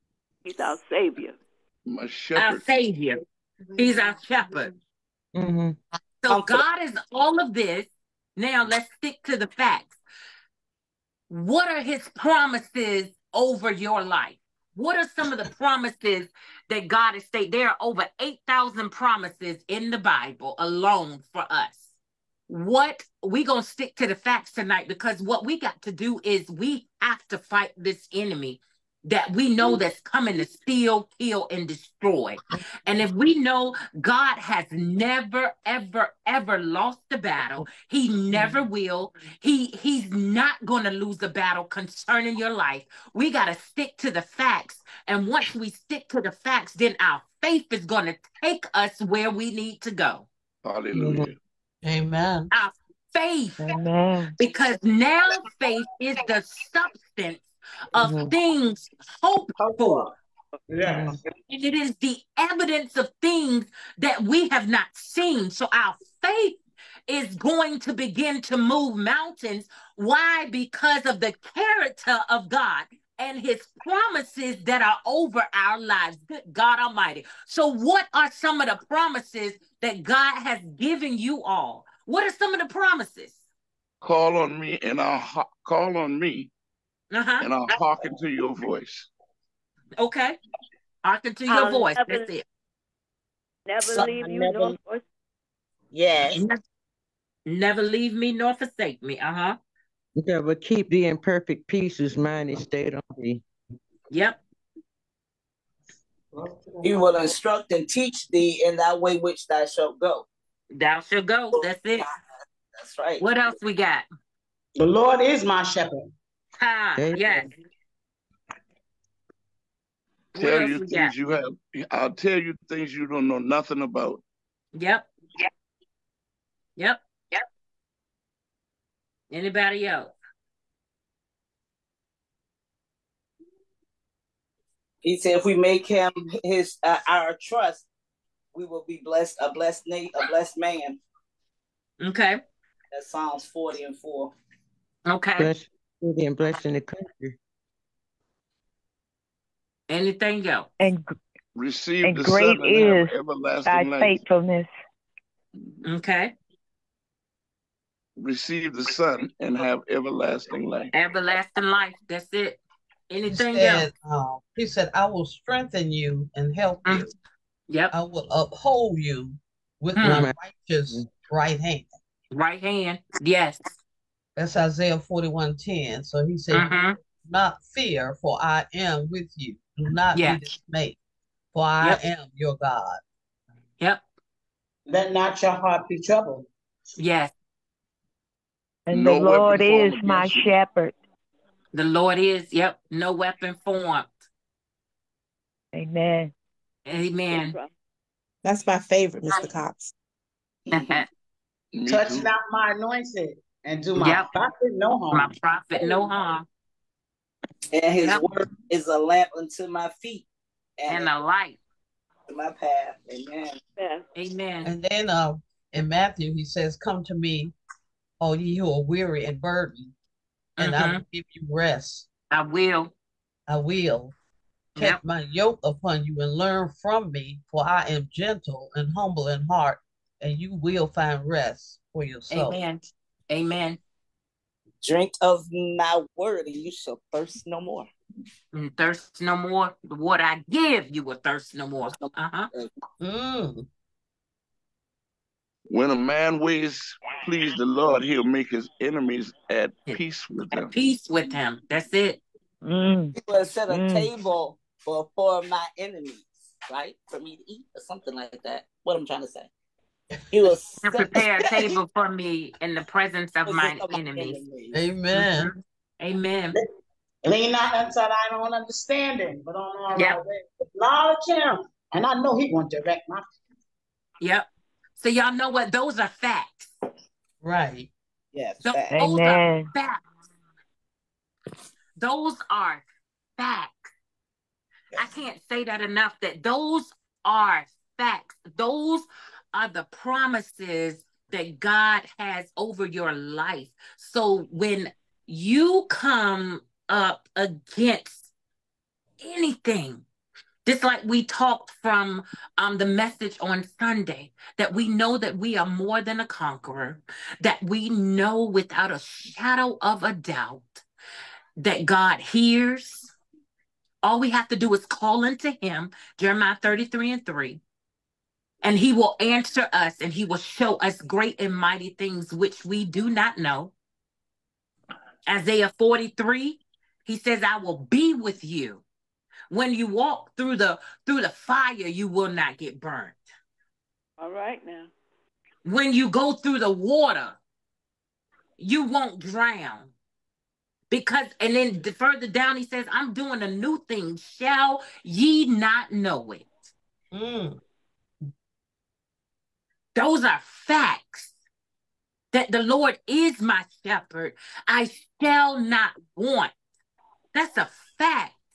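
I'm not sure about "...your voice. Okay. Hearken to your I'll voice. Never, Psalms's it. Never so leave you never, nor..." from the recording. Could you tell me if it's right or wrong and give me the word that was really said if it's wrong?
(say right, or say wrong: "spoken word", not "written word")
wrong: "That", not "Psalms".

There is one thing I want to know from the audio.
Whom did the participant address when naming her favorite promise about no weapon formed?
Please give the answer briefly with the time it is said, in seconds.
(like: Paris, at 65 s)
Mr. Cox, at 199 s.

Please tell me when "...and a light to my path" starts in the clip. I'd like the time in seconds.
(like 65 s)
210 s.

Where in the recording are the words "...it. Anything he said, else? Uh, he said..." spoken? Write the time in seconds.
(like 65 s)
162 s.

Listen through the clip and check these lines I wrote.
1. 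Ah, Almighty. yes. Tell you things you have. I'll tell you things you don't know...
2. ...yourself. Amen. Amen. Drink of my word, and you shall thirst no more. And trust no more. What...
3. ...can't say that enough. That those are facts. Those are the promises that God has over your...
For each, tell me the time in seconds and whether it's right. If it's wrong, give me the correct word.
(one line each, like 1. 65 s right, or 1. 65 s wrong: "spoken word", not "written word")
1. 116 s wrong: "Amen", not "Almighty"
2. 232 s wrong: "thirst", not "trust"
3. 285 s right.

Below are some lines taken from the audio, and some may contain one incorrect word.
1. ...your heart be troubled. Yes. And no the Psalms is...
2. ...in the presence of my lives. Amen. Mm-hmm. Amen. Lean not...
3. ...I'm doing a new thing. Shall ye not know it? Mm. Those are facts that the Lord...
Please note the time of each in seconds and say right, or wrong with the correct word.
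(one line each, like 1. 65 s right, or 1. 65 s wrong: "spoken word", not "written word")
1. 185 s wrong: "Lord", not "Psalms"
2. 262 s wrong: "enemies", not "lives"
3. 342 s right.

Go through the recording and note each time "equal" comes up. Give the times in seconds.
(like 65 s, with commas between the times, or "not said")
not said.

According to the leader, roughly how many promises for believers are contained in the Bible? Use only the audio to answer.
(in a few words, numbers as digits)
over 8,000.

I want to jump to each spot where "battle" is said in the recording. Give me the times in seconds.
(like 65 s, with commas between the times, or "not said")
37 s, 41 s.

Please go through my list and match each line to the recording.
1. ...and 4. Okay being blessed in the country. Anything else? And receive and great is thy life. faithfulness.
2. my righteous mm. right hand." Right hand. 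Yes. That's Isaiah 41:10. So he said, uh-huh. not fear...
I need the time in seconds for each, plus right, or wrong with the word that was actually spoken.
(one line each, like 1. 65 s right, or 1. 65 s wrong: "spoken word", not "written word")
1. 143 s right
2. 170 s right.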